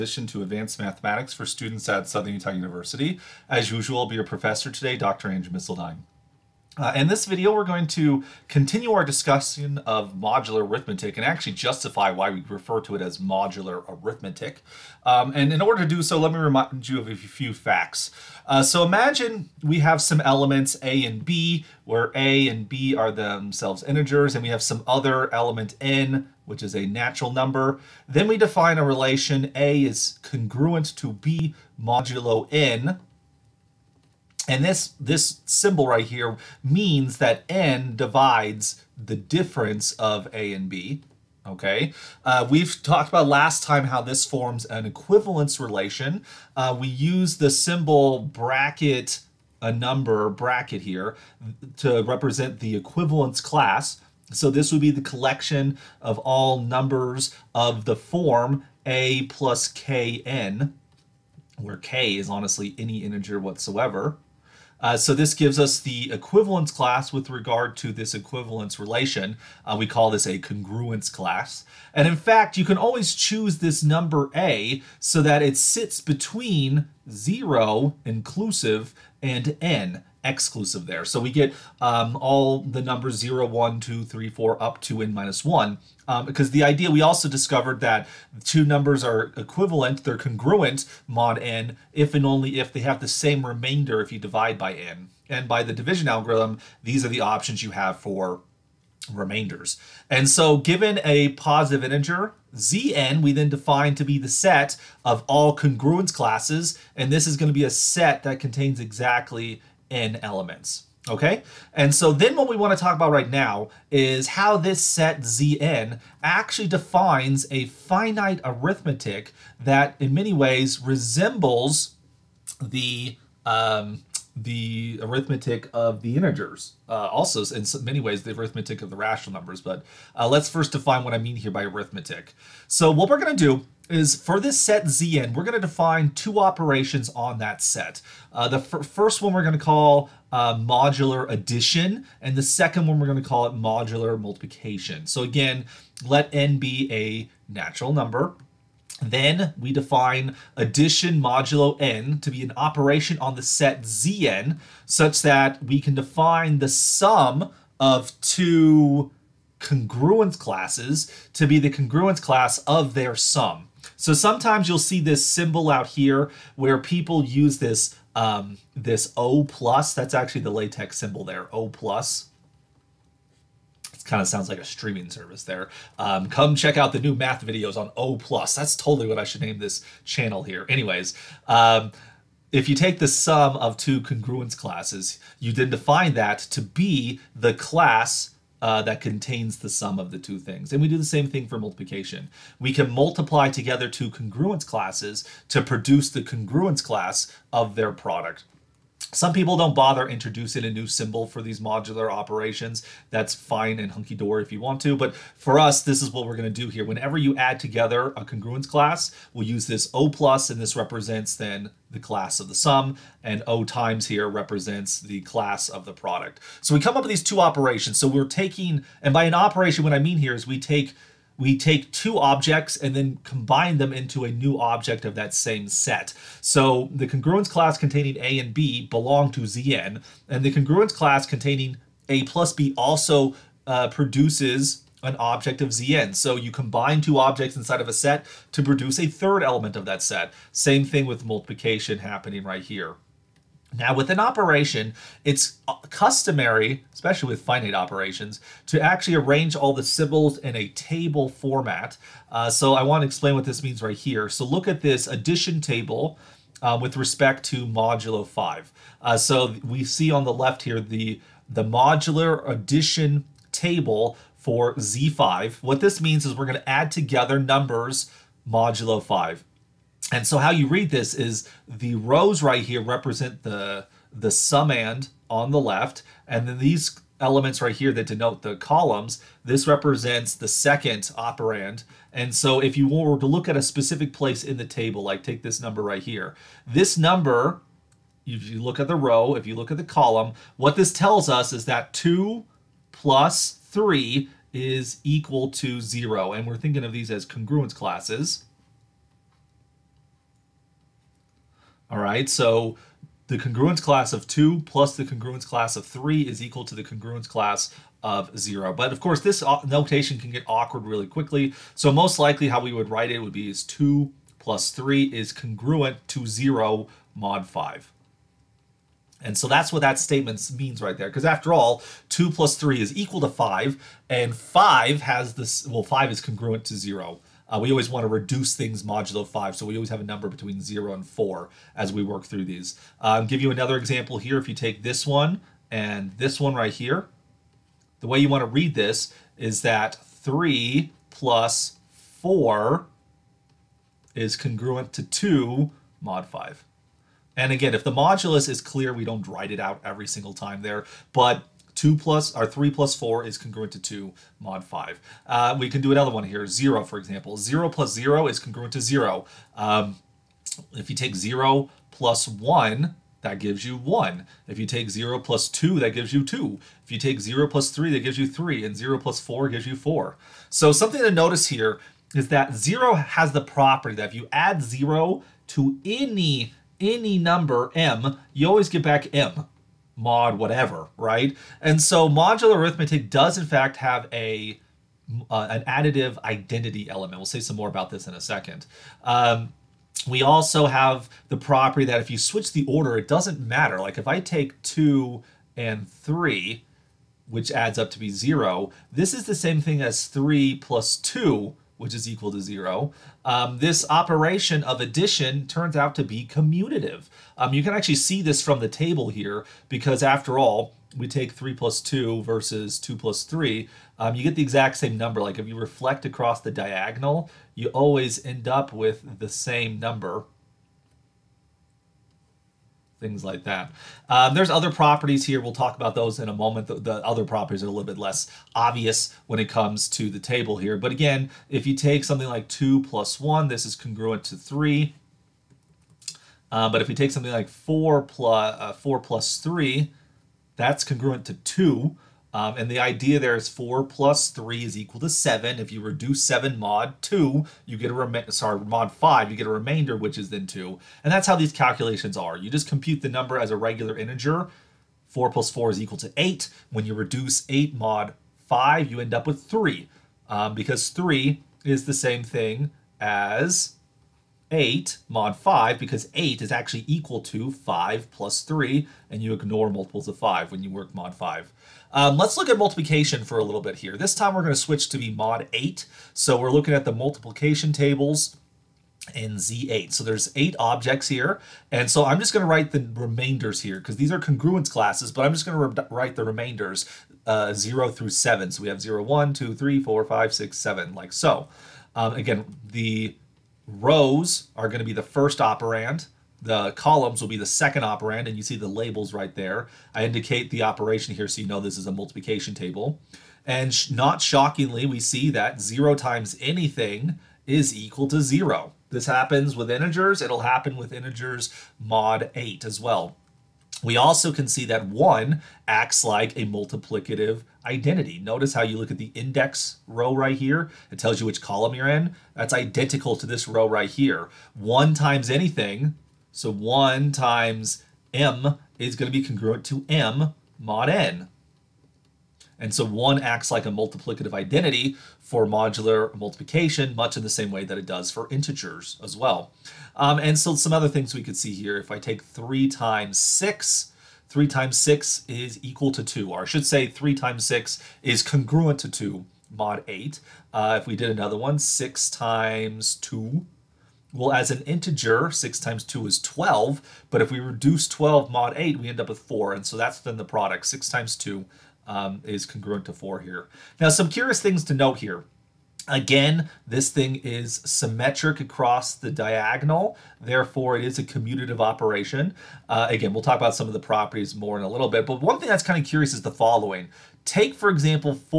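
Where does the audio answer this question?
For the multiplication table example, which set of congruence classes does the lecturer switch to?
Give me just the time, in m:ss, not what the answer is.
7:59.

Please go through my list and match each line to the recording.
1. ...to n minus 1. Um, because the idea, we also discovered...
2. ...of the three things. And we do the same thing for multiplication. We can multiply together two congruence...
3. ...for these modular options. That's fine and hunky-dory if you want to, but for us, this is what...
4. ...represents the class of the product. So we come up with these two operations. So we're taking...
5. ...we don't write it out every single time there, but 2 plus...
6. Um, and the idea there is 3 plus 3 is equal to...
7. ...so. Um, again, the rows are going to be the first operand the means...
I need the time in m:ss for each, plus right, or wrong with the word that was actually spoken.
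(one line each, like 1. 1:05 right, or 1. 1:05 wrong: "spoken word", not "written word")
1. 1:24 right
2. 3:09 wrong: "two", not "three"
3. 3:21 wrong: "operations", not "options"
4. 3:34 right
5. 5:48 right
6. 7:22 wrong: "4", not "3"
7. 8:11 wrong: "columns", not "means".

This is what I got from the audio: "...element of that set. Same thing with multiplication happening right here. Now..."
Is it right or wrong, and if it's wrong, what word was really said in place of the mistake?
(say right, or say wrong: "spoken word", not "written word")
right.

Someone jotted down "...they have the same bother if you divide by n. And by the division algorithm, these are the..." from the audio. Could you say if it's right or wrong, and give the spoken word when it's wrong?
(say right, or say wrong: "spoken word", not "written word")
wrong: "remainder", not "bother".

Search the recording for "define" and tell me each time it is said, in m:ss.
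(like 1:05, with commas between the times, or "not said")
0:28, 1:43, 1:56, 2:10, 2:15, 2:29, 2:35, 3:05.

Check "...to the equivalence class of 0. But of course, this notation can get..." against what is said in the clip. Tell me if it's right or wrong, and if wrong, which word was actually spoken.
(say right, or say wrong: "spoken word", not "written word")
wrong: "congruence", not "equivalence".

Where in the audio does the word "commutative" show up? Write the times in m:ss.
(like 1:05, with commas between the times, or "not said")
6:46, 9:31.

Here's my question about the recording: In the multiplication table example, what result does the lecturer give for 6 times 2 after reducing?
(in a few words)
4.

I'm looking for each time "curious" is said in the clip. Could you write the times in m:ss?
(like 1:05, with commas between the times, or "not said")
9:24, 9:35.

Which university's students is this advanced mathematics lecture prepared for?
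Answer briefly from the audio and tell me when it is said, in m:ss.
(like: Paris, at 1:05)
Southern Utah University, at 0:02.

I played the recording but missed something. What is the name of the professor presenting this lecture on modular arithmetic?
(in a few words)
Andrew Misseldine.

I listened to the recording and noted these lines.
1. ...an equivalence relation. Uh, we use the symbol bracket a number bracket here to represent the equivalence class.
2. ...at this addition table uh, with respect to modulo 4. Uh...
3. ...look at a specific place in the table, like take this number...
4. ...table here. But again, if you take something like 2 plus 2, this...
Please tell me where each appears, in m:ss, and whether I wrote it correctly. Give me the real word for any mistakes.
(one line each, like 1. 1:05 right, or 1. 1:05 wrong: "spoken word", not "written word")
1. 0:44 right
2. 4:14 wrong: "5", not "4"
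3. 4:43 right
4. 7:10 wrong: "1", not "2".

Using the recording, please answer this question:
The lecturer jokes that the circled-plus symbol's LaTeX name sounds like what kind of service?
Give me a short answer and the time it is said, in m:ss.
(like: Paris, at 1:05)
streaming service, at 2:54.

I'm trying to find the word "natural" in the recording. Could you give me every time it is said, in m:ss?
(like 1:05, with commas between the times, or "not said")
0:26, 2:27.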